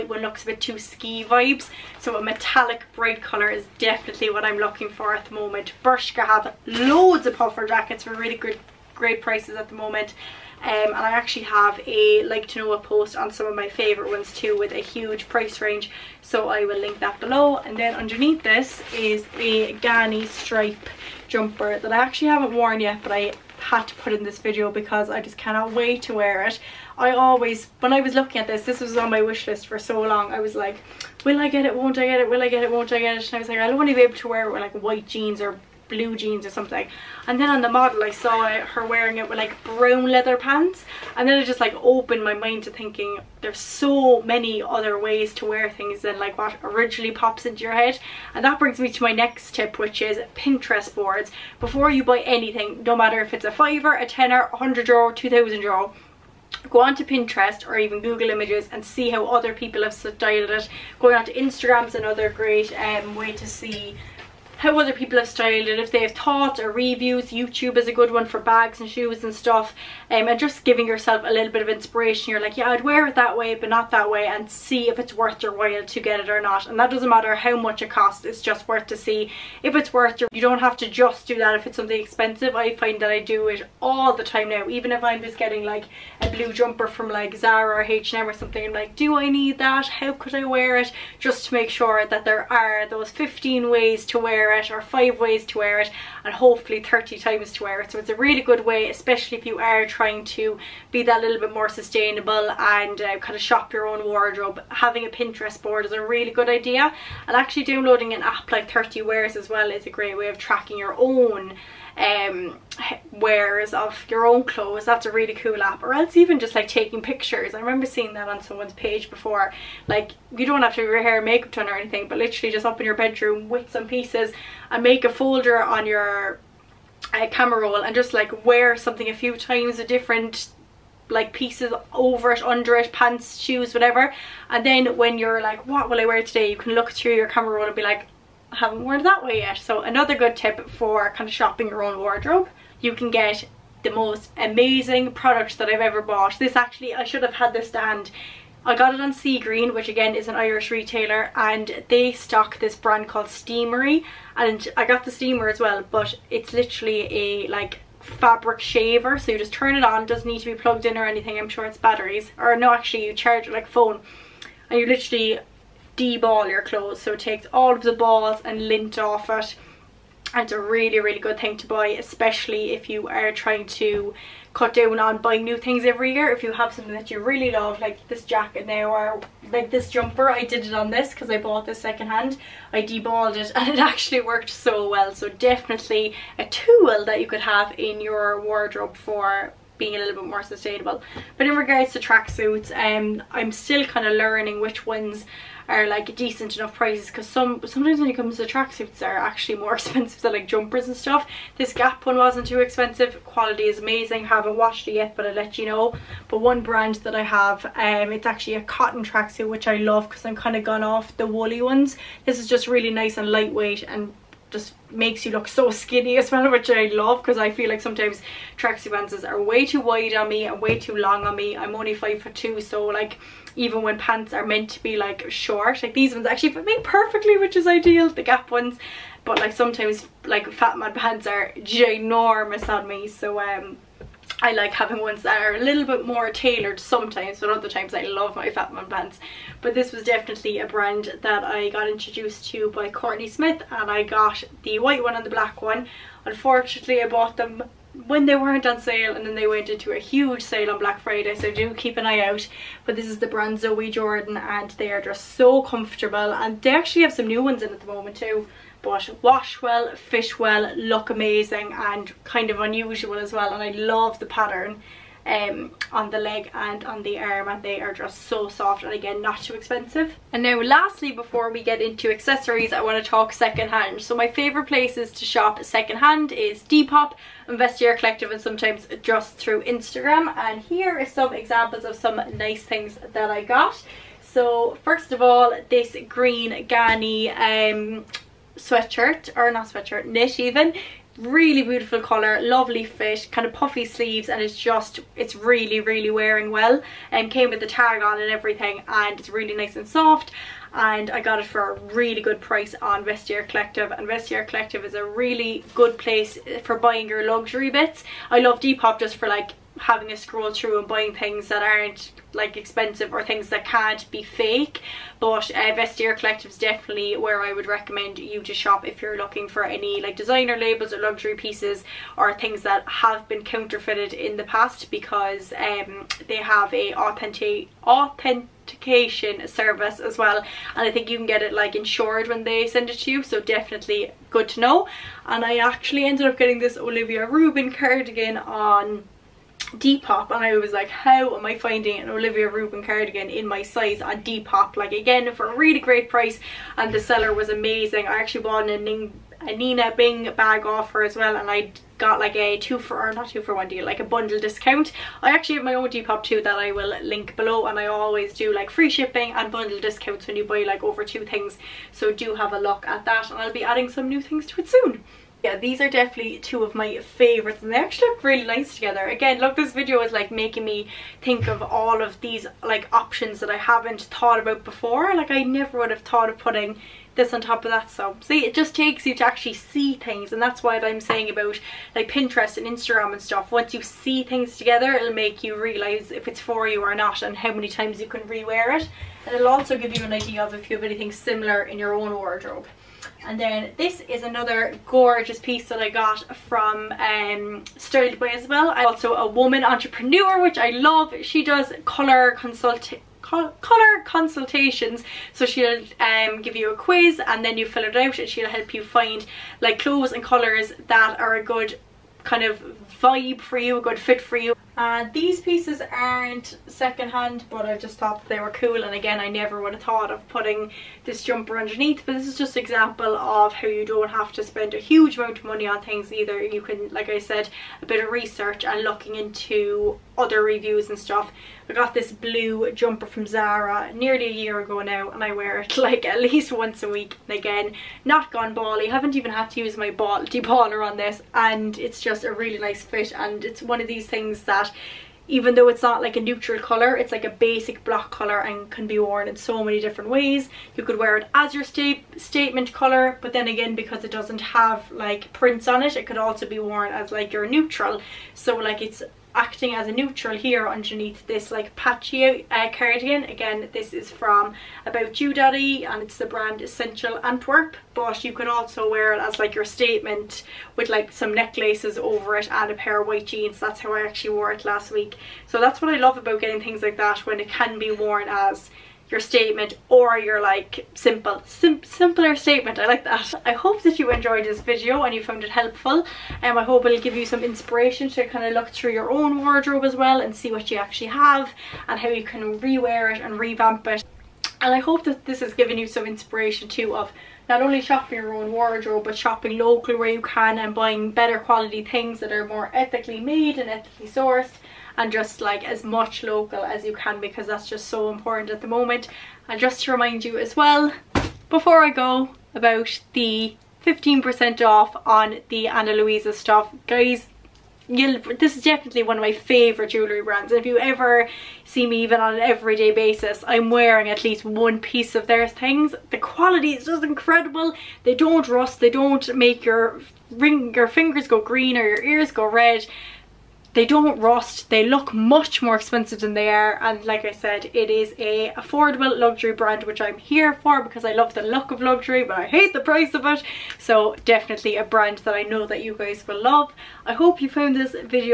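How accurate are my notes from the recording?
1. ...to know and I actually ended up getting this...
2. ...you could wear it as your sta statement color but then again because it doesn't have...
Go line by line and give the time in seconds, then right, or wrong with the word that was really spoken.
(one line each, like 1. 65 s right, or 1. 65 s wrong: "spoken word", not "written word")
1. 334 s right
2. 450 s right.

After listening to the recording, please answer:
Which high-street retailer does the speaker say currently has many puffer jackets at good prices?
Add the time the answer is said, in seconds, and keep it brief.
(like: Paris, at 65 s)
Bershka, at 5 s.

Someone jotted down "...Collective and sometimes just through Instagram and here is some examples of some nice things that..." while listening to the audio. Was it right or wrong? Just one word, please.
right.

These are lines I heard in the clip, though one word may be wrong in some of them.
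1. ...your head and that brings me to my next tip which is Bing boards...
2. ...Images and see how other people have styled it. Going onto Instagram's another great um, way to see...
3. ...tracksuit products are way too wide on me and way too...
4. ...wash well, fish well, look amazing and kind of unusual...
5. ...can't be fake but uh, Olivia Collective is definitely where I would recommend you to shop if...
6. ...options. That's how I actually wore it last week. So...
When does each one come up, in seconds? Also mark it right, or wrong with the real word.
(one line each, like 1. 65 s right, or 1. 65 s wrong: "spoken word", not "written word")
1. 47 s wrong: "Pinterest", not "Bing"
2. 58 s right
3. 218 s wrong: "pants", not "products"
4. 259 s right
5. 313 s wrong: "Vestiaire", not "Olivia"
6. 473 s wrong: "jeans", not "options".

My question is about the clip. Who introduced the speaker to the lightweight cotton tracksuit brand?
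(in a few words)
Courtney Smith.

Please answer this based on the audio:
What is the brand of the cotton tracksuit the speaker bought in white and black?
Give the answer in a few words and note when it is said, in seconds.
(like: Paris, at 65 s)
Zoe Jordan, at 253 s.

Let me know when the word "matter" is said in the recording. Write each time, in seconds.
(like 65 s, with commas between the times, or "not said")
52 s, 77 s.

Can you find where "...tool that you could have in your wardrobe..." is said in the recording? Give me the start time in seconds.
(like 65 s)
186 s.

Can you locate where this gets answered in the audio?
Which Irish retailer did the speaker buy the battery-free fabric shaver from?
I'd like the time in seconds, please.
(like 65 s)
149 s.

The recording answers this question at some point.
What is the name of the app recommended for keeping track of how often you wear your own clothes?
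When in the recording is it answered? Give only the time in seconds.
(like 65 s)
108 s.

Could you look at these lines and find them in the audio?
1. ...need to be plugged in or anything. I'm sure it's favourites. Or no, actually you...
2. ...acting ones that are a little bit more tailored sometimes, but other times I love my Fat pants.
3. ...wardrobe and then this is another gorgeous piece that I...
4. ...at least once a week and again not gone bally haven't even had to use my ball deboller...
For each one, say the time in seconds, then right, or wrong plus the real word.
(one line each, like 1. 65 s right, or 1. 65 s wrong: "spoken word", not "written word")
1. 160 s wrong: "batteries", not "favourites"
2. 234 s wrong: "having", not "acting"
3. 392 s right
4. 436 s right.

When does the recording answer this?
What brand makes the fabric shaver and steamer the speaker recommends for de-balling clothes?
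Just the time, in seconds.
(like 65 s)
153 s.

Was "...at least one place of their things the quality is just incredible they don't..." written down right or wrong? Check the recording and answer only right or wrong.
wrong.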